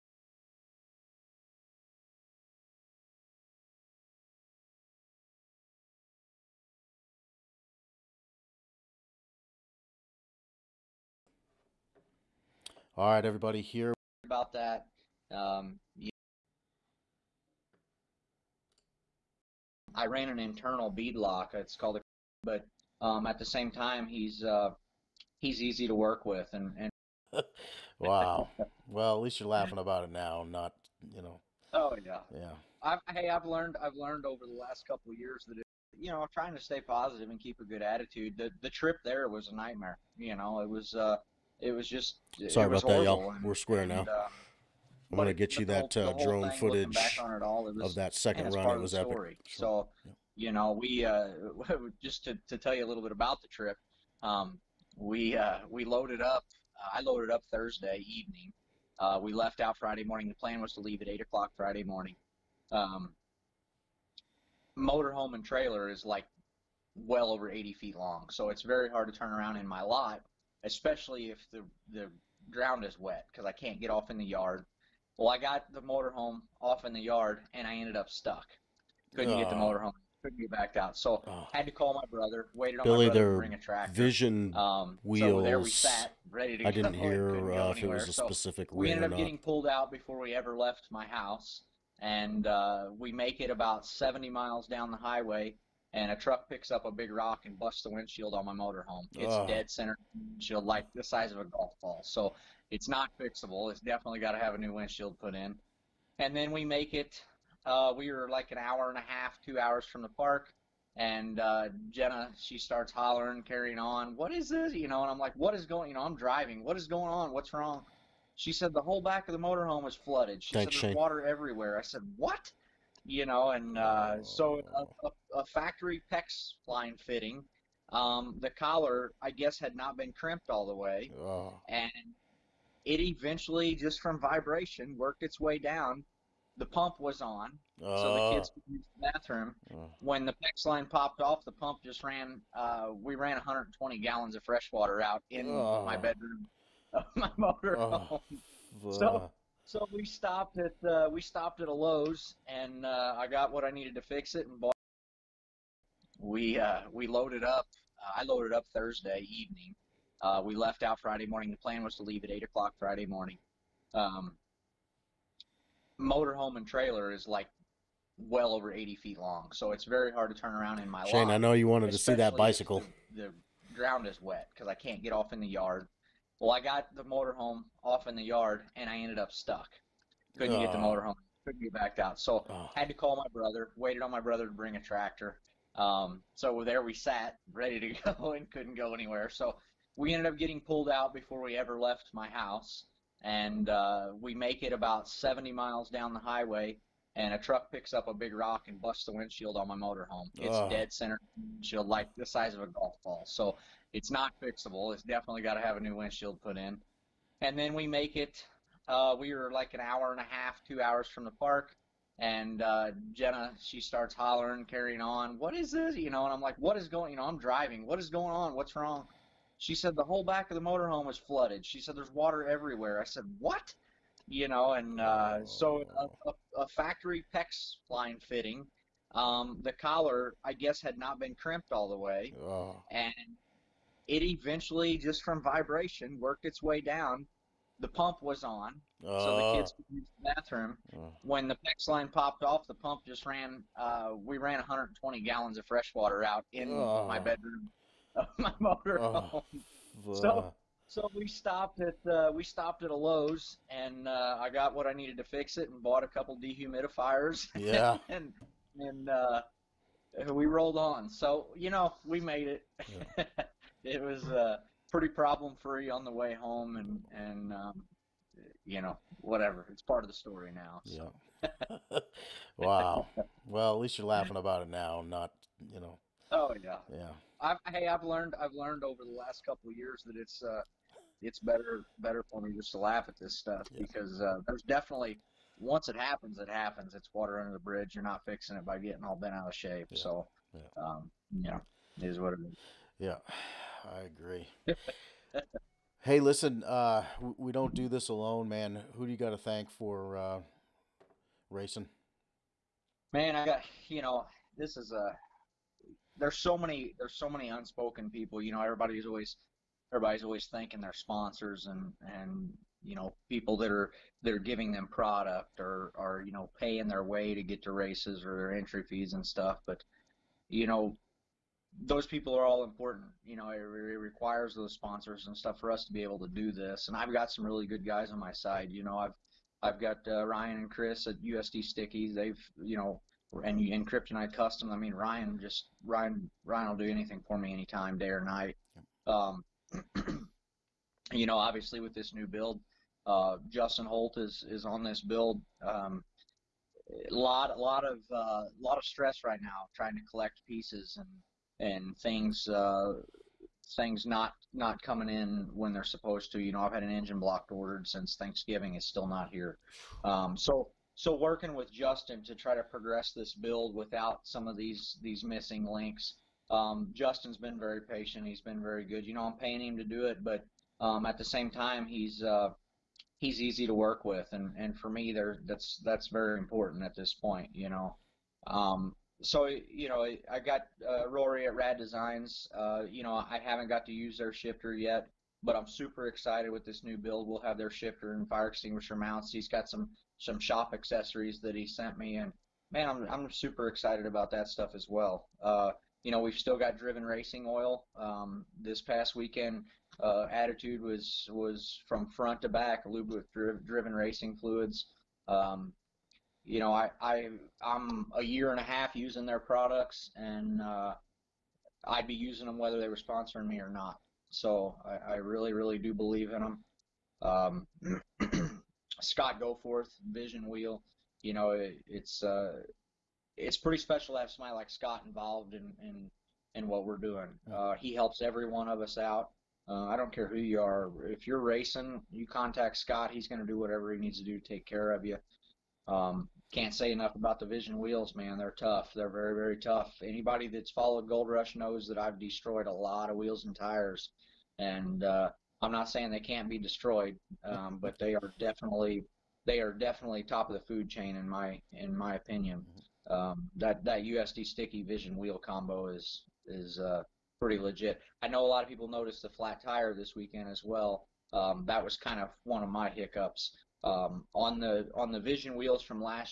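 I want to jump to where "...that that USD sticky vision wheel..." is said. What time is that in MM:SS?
07:33.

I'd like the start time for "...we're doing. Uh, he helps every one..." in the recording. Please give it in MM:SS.
07:06.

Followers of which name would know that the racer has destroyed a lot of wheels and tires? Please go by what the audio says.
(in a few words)
Gold Rush.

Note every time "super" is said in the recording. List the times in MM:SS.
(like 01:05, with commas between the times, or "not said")
06:25, 06:33.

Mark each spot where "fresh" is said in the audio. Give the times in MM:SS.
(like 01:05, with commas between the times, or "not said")
02:24, 04:05.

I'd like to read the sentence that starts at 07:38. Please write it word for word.
I know a lot of people noticed the flat tire this weekend as well.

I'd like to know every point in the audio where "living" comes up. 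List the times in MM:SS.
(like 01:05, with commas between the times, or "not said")
not said.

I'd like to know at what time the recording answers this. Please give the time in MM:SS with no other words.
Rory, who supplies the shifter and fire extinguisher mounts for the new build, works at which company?
06:21.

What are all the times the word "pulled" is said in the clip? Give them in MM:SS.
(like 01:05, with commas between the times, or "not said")
01:29, 03:10.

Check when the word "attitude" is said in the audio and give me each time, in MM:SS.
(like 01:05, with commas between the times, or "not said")
00:37, 06:40.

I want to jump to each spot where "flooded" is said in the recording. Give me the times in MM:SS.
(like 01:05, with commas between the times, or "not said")
01:59, 03:41.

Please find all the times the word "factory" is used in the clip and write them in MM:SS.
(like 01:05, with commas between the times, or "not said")
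02:05, 03:46.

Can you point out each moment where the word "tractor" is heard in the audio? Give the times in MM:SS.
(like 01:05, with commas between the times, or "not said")
01:23, 03:04.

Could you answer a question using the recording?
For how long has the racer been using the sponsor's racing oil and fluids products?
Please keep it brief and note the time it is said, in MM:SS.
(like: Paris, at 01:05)
a year and a half, at 06:48.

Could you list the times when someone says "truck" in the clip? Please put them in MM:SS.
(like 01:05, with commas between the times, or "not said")
01:36, 03:17.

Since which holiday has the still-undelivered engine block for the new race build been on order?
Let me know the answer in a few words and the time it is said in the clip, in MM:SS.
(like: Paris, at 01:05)
Thanksgiving, at 05:58.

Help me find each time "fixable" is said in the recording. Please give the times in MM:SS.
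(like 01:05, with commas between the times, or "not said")
01:43, 03:24.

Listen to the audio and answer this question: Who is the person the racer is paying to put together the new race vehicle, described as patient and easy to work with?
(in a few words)
Justin Holt.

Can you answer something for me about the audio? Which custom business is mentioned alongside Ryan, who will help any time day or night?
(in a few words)
Kryptonite Custom.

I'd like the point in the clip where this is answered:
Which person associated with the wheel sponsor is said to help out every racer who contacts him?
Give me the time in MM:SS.
06:59.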